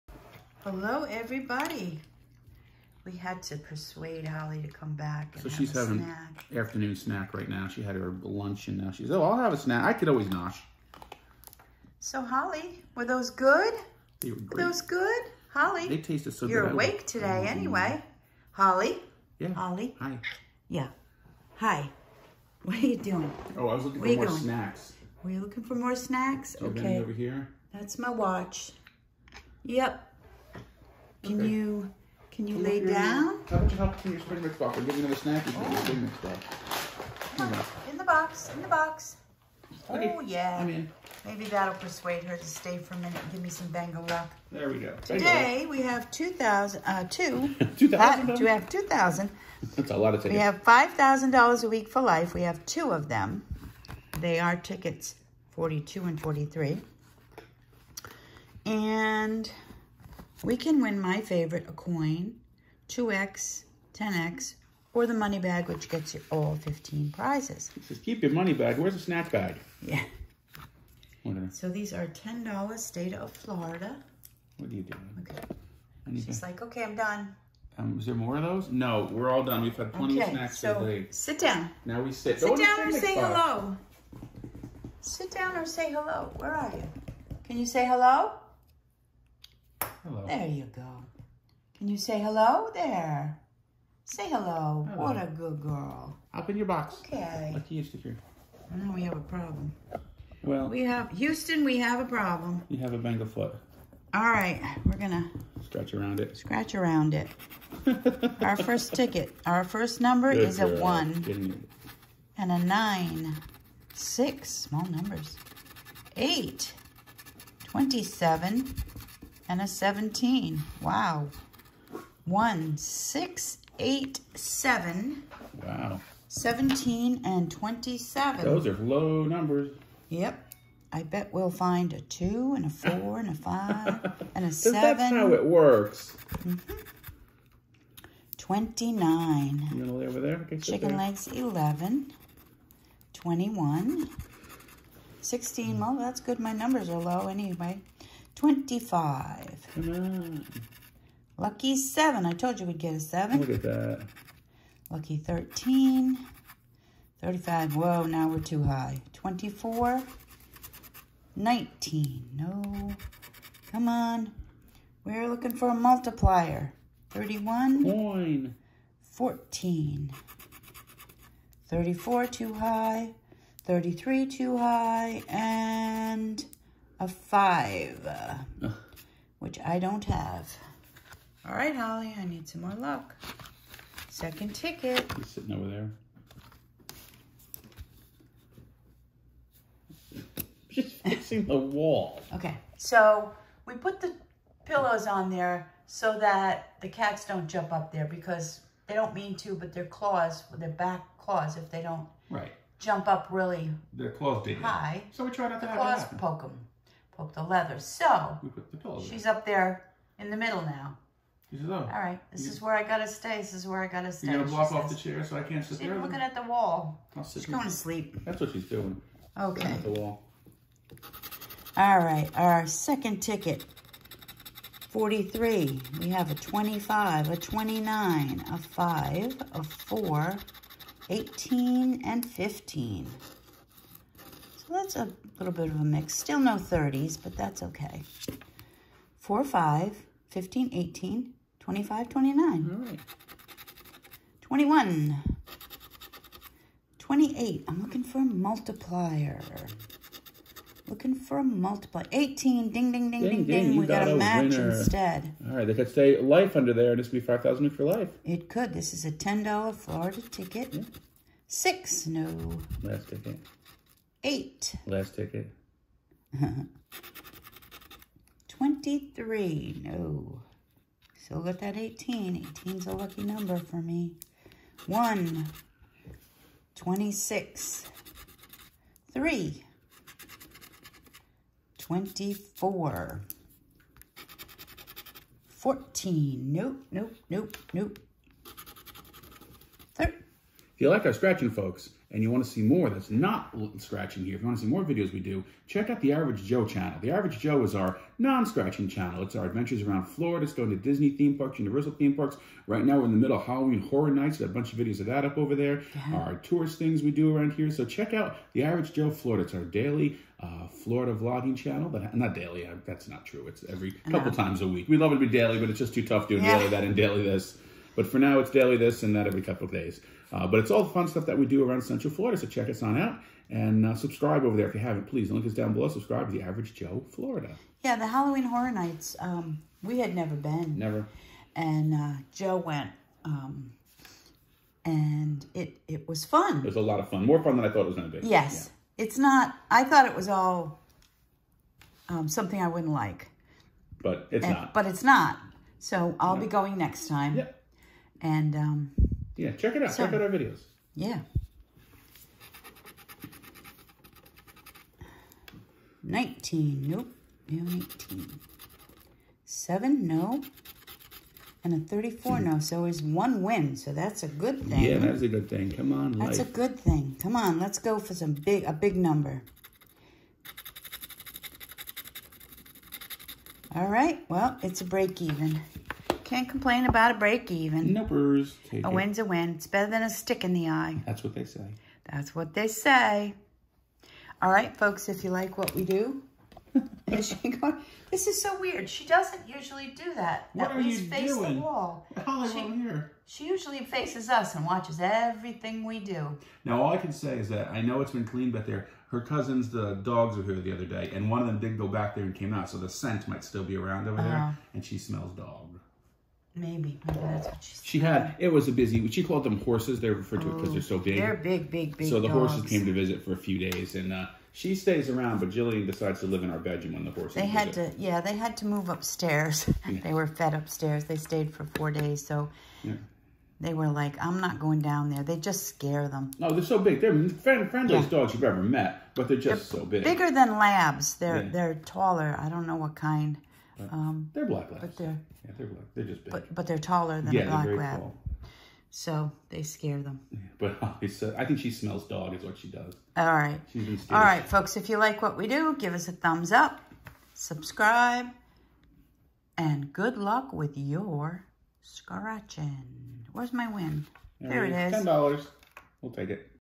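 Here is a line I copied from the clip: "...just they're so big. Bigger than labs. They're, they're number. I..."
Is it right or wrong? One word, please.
wrong.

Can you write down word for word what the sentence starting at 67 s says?
It says, keep your money bag.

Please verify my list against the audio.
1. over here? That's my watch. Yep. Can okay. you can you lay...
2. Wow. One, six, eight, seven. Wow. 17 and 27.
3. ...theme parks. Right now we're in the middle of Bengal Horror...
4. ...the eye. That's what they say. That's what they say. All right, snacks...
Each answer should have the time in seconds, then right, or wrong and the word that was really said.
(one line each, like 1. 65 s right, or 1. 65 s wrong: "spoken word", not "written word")
1. 26 s right
2. 120 s right
3. 301 s wrong: "Halloween", not "Bengal"
4. 380 s wrong: "folks", not "snacks".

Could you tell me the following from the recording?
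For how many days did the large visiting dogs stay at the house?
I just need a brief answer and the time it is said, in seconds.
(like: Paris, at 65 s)
4, at 421 s.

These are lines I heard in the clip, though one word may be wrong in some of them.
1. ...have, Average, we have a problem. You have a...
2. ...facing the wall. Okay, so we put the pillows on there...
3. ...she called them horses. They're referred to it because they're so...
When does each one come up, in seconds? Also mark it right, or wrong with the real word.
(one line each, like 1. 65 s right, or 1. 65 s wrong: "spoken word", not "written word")
1. 100 s wrong: "Houston", not "Average"
2. 190 s right
3. 409 s right.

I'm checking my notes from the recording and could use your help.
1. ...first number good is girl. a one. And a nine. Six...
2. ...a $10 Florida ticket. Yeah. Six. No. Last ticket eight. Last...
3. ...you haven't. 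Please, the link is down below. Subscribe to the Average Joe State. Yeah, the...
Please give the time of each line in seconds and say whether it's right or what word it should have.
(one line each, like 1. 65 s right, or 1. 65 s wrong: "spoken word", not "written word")
1. 109 s right
2. 259 s right
3. 324 s wrong: "Florida", not "State".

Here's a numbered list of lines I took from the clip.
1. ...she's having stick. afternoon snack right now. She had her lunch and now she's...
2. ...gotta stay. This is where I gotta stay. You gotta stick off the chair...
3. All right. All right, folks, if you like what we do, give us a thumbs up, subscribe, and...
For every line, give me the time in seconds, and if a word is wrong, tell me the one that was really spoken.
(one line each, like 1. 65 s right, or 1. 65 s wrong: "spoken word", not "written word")
1. 5 s wrong: "snack", not "stick"
2. 212 s wrong: "block", not "stick"
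3. 443 s right.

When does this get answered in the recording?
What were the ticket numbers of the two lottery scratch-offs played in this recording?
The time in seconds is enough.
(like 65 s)
54 s.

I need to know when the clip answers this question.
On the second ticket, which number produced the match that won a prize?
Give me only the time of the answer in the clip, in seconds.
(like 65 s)
252 s.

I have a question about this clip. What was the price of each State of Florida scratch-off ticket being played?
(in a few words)
$10.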